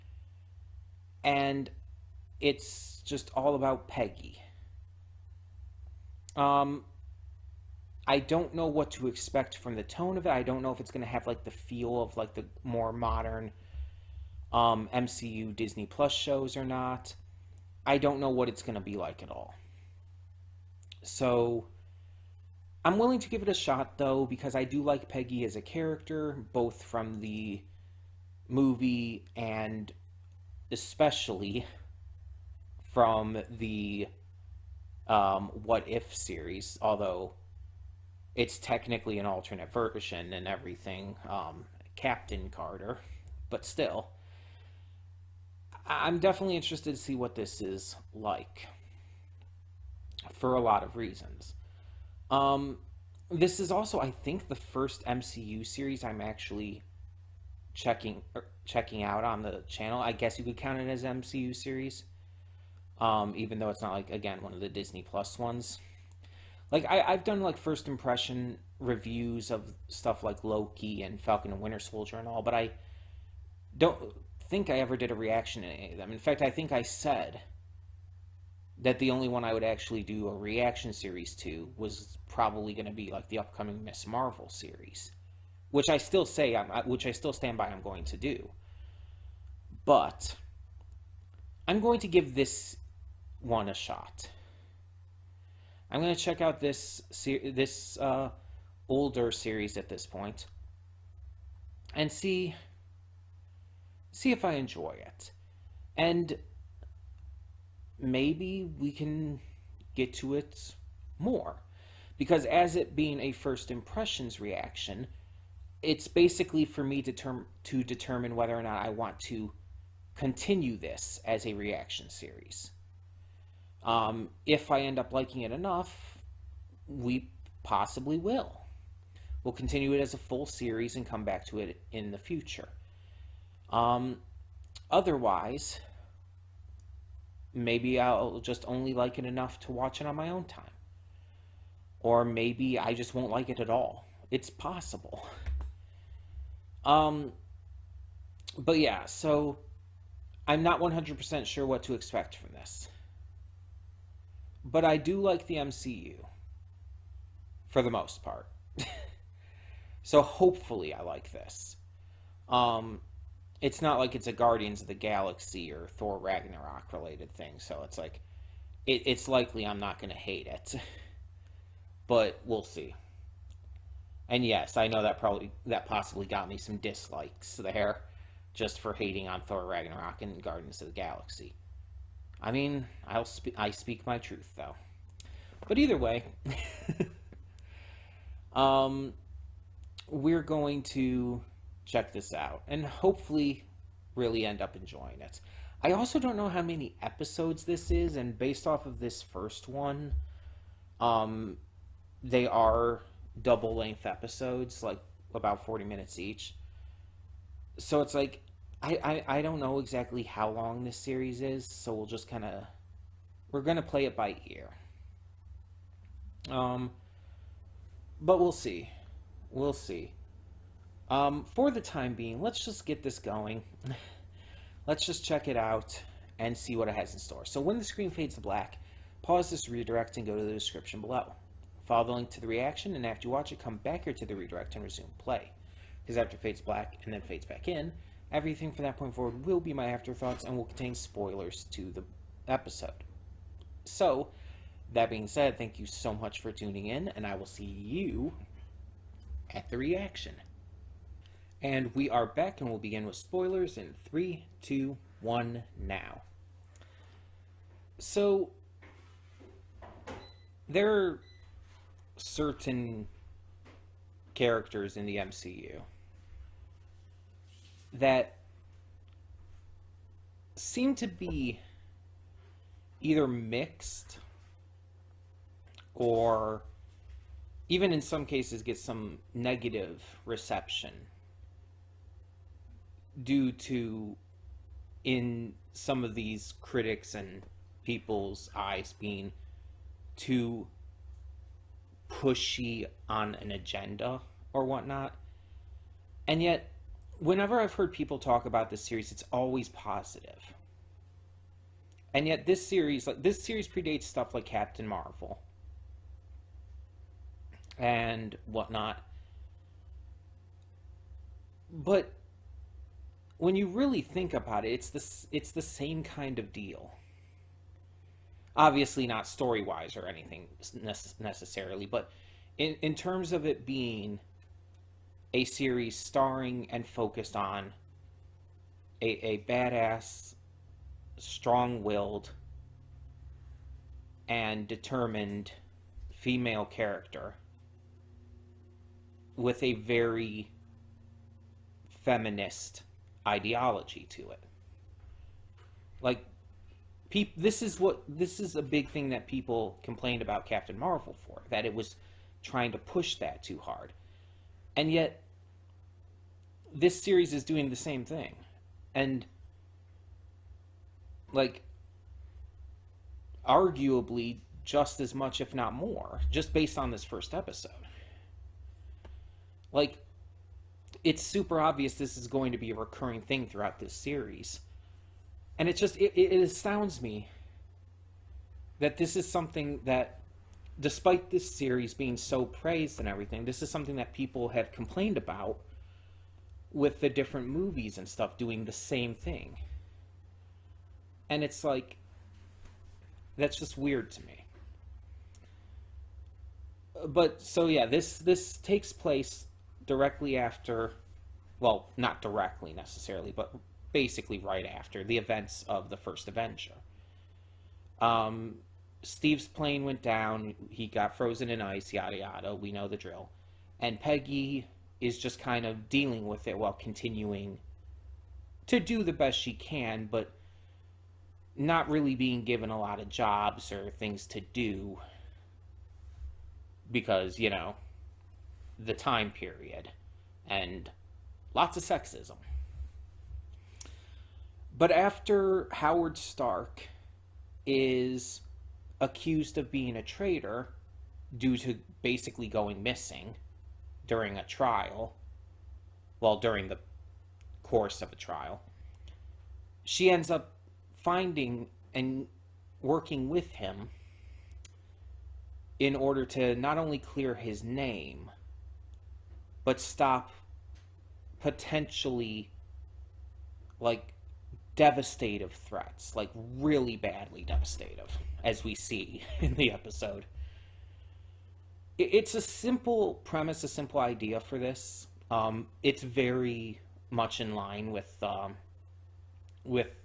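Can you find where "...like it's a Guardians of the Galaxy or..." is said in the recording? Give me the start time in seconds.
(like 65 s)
163 s.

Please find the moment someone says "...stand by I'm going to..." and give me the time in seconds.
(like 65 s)
87 s.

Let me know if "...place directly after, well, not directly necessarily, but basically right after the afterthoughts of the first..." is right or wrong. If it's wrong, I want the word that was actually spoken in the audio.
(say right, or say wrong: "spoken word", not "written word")
wrong: "events", not "afterthoughts".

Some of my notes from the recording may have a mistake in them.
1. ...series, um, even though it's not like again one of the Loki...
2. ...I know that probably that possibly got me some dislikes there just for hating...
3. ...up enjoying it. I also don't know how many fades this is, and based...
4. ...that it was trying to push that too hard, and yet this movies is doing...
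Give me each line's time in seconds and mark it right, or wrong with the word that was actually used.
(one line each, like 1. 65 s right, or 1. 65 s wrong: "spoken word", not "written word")
1. 61 s wrong: "Disney", not "Loki"
2. 174 s right
3. 194 s wrong: "episodes", not "fades"
4. 351 s wrong: "series", not "movies".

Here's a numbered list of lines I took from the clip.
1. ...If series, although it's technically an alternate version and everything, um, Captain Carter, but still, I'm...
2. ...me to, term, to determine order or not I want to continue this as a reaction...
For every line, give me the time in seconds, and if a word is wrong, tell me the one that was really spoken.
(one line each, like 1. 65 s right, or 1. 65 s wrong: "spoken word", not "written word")
1. 35 s right
2. 116 s wrong: "whether", not "order".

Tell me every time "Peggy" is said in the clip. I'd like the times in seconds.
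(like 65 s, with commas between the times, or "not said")
3 s, 25 s, 413 s.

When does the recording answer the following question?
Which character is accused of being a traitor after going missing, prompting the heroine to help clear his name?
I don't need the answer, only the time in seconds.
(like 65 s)
435 s.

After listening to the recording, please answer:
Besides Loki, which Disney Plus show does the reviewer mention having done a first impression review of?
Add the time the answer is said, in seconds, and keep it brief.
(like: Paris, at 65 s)
Falcon and Winter Soldier, at 71 s.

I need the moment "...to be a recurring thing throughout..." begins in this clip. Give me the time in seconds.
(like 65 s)
372 s.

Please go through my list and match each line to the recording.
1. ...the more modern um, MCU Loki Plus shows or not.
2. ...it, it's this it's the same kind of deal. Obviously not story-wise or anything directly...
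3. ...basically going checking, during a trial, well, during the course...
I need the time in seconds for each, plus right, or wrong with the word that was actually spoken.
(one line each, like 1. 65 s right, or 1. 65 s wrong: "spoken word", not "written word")
1. 12 s wrong: "Disney", not "Loki"
2. 314 s wrong: "necessarily", not "directly"
3. 442 s wrong: "missing", not "checking".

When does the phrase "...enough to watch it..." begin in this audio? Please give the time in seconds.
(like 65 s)
139 s.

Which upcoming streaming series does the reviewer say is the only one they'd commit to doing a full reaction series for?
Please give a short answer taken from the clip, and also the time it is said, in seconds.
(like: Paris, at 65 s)
Miss Marvel, at 83 s.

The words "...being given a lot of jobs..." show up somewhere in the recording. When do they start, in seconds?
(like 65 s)
422 s.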